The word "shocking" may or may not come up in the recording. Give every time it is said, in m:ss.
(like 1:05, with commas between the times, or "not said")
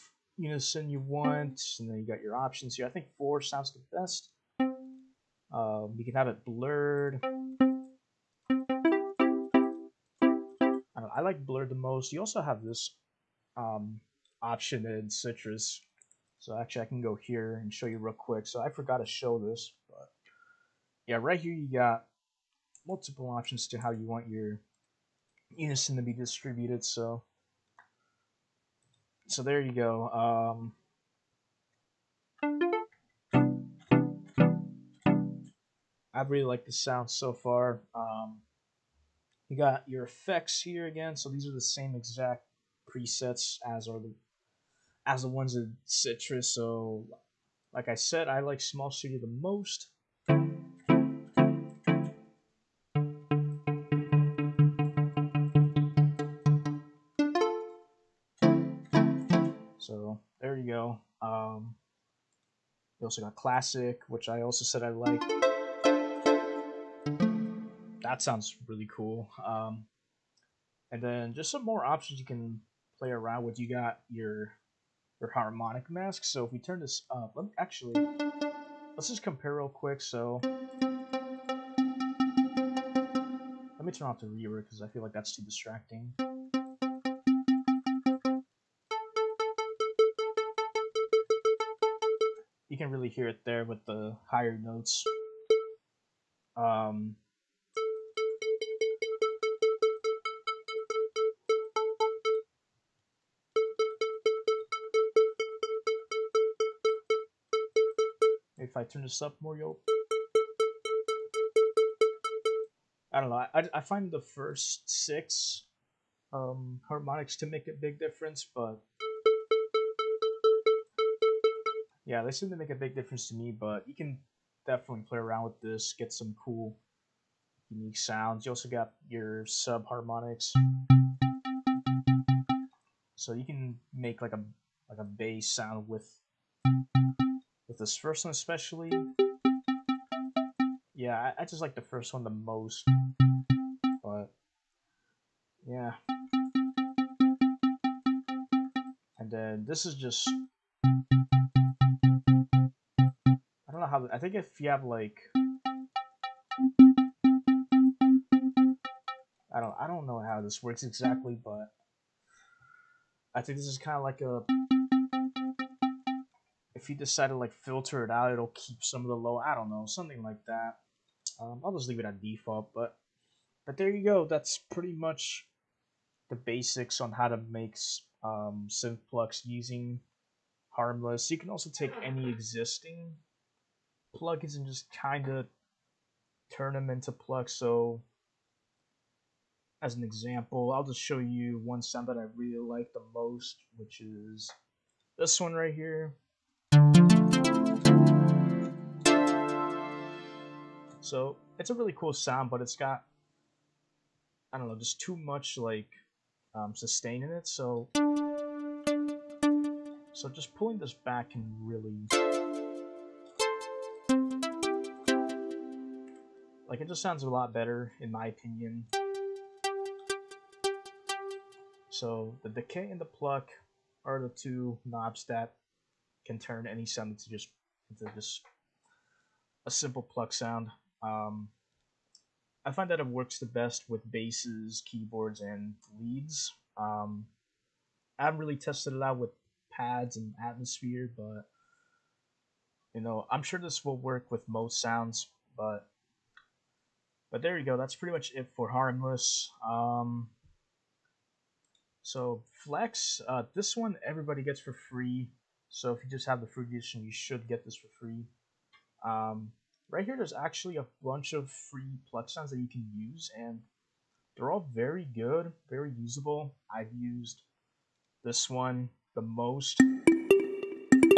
not said.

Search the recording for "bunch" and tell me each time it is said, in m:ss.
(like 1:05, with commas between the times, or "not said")
4:21.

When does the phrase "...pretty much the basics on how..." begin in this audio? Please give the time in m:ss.
2:54.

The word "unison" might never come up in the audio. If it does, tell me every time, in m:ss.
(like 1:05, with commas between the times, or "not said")
0:00, 0:25.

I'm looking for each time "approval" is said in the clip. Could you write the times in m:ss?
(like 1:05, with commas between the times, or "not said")
not said.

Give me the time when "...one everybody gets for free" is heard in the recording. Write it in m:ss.
4:13.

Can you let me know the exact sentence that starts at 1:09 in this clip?
Um, and then just some more options you can play around with.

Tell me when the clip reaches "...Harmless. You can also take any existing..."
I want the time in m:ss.
3:00.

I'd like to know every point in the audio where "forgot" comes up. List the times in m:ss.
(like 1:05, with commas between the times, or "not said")
0:18.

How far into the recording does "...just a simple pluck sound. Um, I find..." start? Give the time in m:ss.
3:48.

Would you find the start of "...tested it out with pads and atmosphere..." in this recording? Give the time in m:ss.
3:58.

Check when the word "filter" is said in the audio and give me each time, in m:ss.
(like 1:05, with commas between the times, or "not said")
2:47.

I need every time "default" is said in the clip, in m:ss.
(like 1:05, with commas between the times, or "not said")
2:52.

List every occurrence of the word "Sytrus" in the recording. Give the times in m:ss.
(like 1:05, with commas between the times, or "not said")
0:15, 0:45.